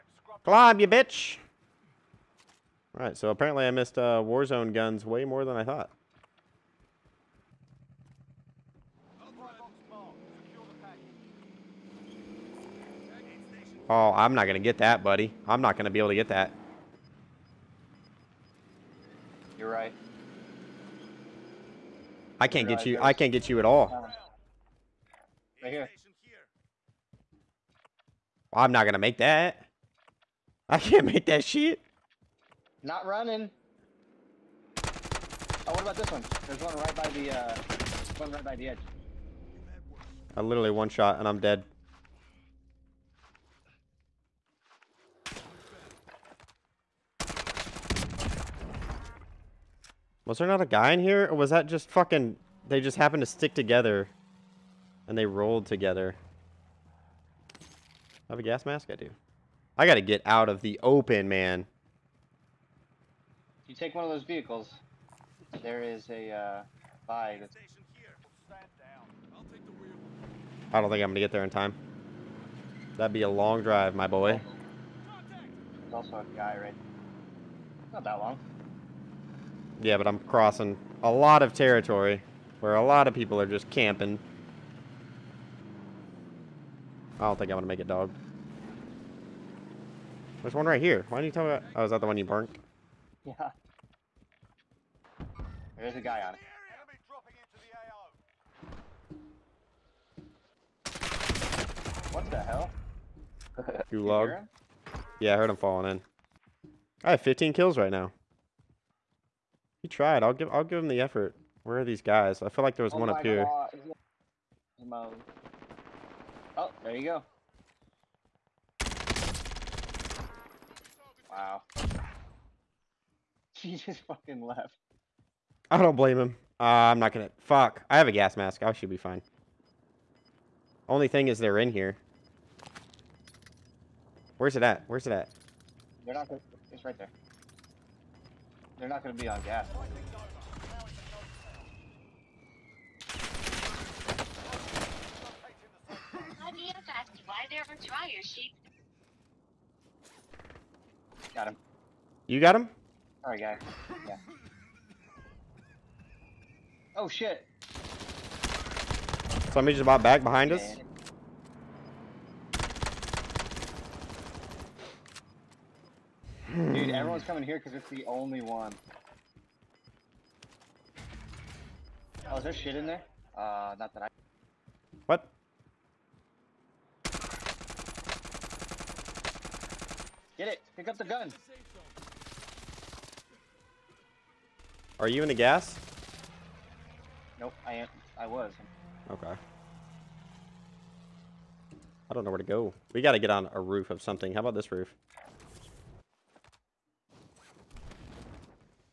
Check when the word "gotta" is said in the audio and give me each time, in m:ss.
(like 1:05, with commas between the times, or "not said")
0:59, 3:13.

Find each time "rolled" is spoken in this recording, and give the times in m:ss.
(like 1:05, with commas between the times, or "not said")
0:55.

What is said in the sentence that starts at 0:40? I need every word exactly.
I literally one shot and I'm dead.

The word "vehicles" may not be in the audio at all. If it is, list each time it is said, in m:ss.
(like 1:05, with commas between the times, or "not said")
1:04.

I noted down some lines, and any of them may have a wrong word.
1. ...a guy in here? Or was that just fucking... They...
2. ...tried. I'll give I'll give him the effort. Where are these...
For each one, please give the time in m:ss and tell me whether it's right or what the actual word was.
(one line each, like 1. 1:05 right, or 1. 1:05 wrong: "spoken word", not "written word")
1. 0:50 right
2. 1:49 right.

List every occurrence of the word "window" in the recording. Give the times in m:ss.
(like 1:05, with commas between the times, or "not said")
not said.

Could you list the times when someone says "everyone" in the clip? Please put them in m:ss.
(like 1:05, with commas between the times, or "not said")
2:46.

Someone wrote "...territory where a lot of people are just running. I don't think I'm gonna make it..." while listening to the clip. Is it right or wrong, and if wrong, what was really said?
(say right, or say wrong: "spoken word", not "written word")
wrong: "camping", not "running".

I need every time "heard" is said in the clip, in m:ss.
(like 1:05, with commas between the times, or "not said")
1:45.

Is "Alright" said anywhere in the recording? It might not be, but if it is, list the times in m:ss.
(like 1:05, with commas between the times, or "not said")
0:02, 2:33.